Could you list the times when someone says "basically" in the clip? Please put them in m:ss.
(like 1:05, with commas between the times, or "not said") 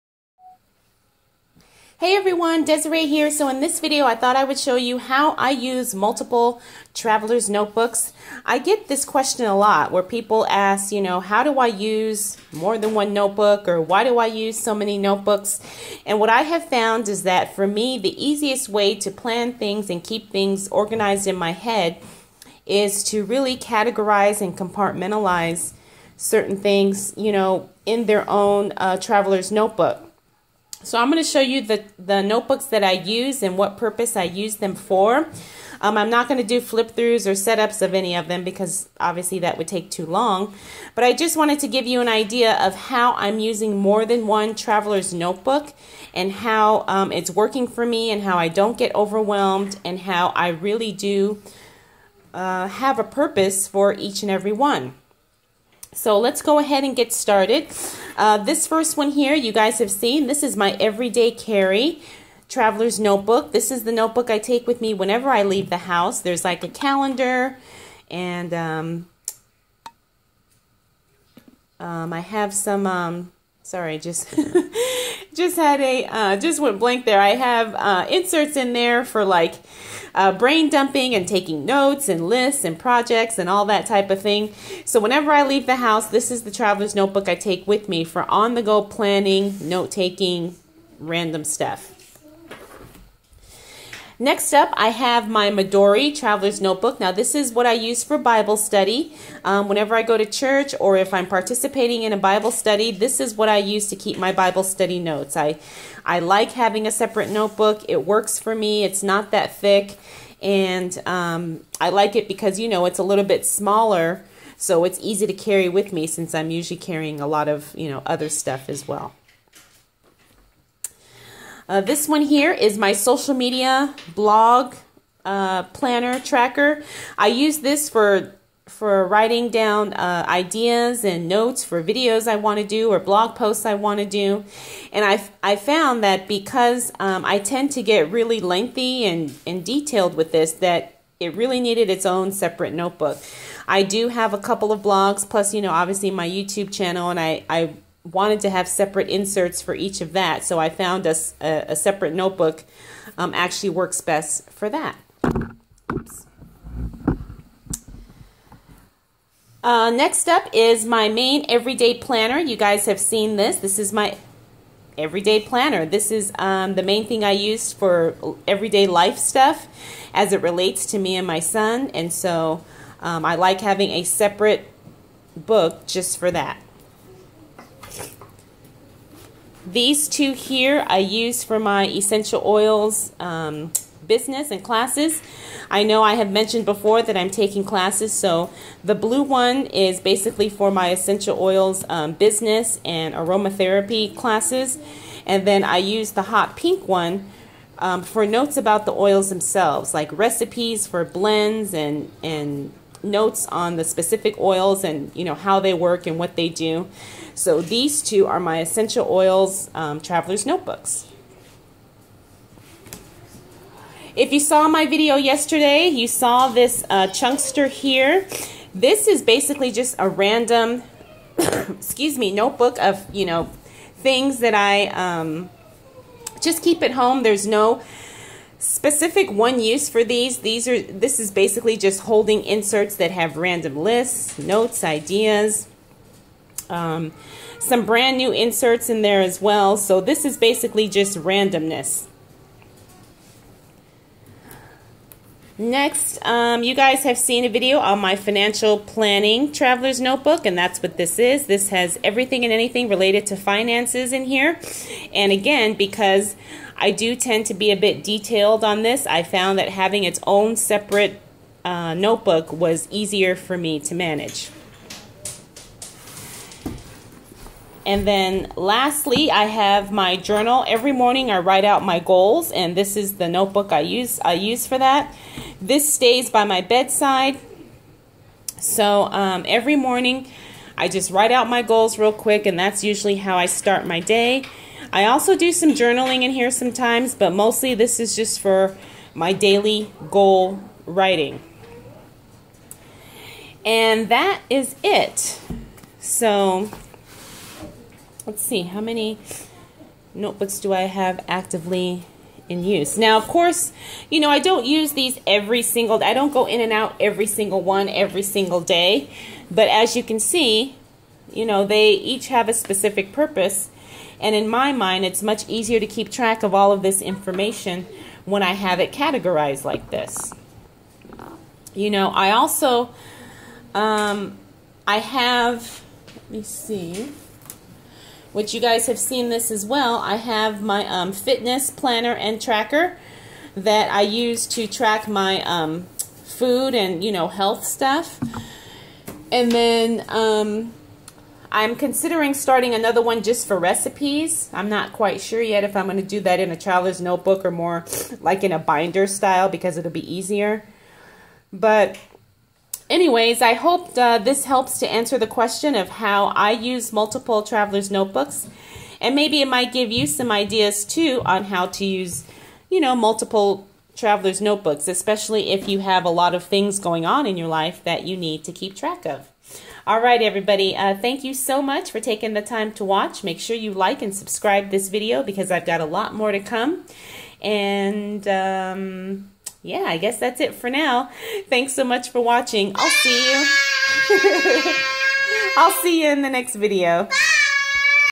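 3:09, 3:39, 3:51, 4:00.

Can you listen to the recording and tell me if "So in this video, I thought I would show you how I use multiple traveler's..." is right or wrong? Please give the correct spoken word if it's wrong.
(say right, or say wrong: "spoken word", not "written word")
right.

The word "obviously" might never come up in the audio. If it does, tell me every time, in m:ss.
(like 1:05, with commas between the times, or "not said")
0:38, 2:25.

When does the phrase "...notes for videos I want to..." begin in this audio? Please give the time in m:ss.
2:11.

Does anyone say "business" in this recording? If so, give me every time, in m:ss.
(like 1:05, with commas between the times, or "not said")
3:04, 3:12.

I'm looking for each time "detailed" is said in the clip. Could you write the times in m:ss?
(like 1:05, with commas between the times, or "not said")
2:19, 4:18.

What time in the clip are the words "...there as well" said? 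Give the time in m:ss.
3:59.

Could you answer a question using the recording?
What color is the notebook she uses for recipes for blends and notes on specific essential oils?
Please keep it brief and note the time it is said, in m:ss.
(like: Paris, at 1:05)
hot pink, at 3:16.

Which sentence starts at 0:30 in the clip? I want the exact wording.
So I'm going to show you the, the notebooks that I use and what purpose I use them for.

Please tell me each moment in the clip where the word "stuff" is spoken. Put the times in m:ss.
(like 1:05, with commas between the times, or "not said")
1:31, 1:58, 2:49, 5:37.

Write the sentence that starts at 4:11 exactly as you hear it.
This has everything and anything related to finances in here.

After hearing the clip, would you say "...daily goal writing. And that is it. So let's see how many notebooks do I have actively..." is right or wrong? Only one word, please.
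right.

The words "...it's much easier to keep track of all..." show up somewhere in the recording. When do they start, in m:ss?
5:15.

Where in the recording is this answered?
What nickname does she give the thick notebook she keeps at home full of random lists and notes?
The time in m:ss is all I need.
3:37.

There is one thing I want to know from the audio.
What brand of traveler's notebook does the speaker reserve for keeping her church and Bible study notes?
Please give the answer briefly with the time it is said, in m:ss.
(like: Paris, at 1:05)
Midori, at 1:35.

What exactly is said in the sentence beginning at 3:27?
So these two are my essential oils um, traveler's notebooks.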